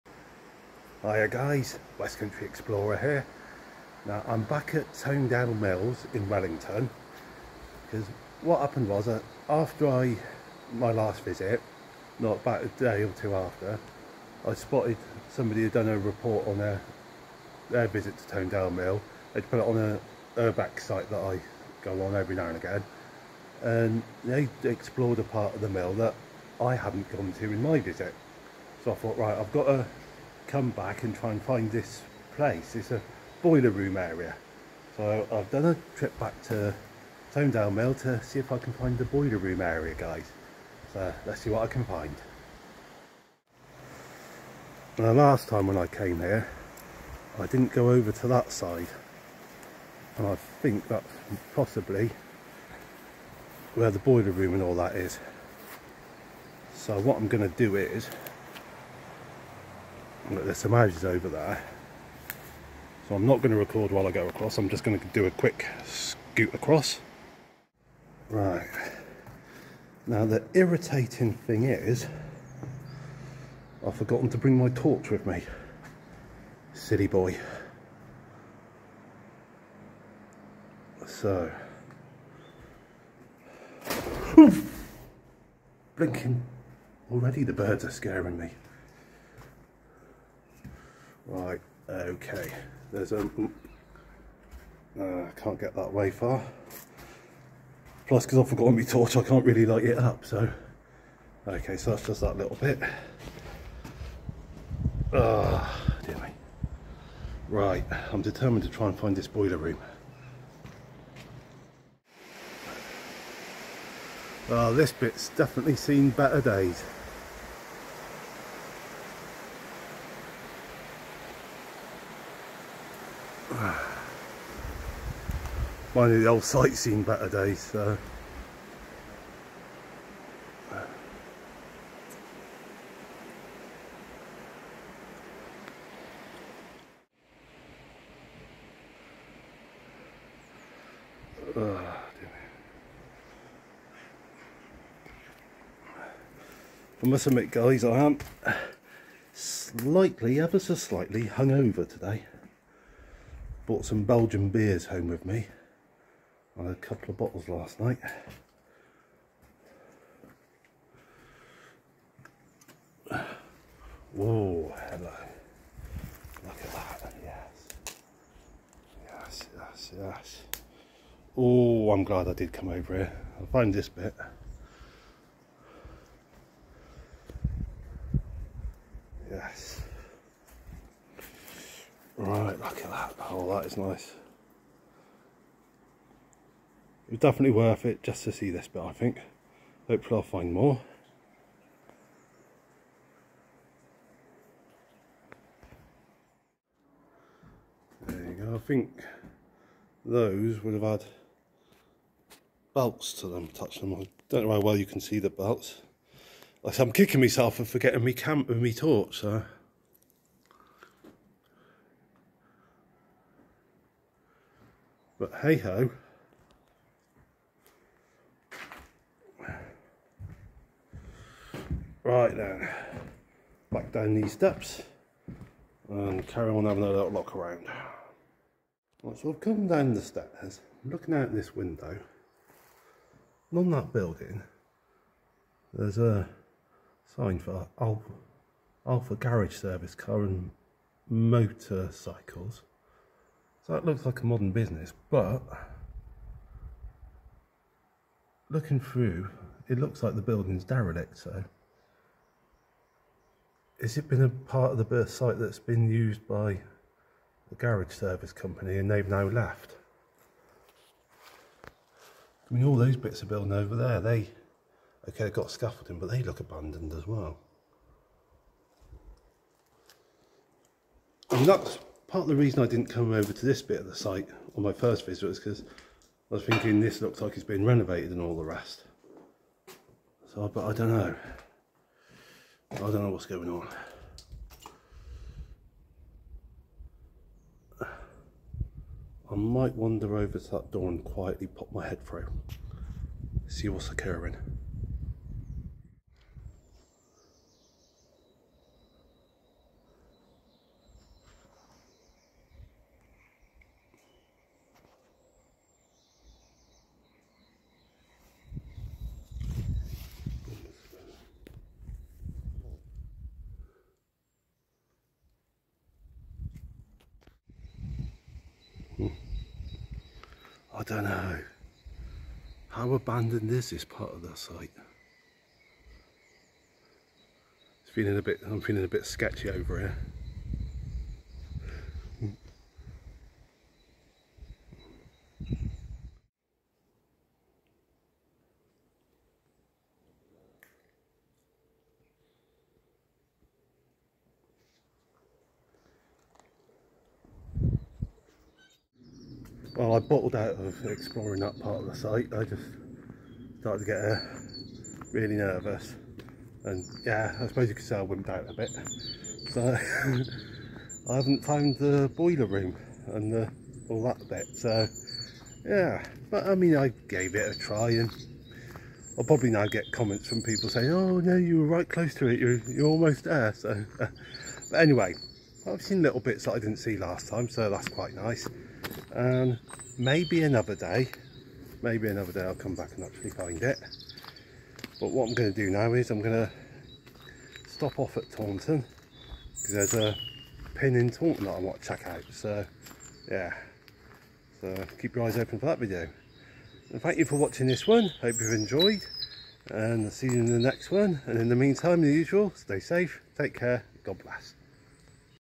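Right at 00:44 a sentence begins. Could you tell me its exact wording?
The last time when I came here, I didn't go over to that side.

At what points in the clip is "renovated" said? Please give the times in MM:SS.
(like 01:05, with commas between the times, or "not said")
04:37.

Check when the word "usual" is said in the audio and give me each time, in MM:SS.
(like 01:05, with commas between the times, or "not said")
06:42.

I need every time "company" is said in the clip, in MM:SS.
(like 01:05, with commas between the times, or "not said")
04:18.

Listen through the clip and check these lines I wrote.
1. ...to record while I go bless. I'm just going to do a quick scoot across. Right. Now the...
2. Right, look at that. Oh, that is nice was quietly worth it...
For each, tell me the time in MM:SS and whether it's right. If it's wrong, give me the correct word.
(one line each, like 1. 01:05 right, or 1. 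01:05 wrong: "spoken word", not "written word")
1. 01:03 wrong: "across", not "bless"
2. 03:02 wrong: "definitely", not "quietly".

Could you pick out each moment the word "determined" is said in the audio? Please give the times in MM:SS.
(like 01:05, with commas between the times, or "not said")
01:48.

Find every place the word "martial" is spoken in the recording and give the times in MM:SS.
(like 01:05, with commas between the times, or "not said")
not said.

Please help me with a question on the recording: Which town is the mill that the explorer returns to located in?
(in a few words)
Wellington.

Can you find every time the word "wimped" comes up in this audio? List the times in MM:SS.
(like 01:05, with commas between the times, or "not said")
05:58.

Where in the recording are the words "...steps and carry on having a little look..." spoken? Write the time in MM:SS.
03:44.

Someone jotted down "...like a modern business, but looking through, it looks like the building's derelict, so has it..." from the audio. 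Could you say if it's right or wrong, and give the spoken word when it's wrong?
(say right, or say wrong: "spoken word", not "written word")
right.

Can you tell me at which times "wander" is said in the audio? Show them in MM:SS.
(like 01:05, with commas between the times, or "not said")
04:49.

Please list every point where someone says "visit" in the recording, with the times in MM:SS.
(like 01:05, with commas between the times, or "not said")
00:11, 00:17, 00:27, 04:35.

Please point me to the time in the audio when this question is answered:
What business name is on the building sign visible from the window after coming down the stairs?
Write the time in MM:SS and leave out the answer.
03:58.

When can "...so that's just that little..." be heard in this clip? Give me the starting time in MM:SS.
01:41.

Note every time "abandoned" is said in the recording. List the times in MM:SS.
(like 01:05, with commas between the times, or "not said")
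04:26, 05:22.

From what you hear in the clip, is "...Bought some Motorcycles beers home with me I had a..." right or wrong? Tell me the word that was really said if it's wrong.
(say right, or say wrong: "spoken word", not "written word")
wrong: "Belgian", not "Motorcycles".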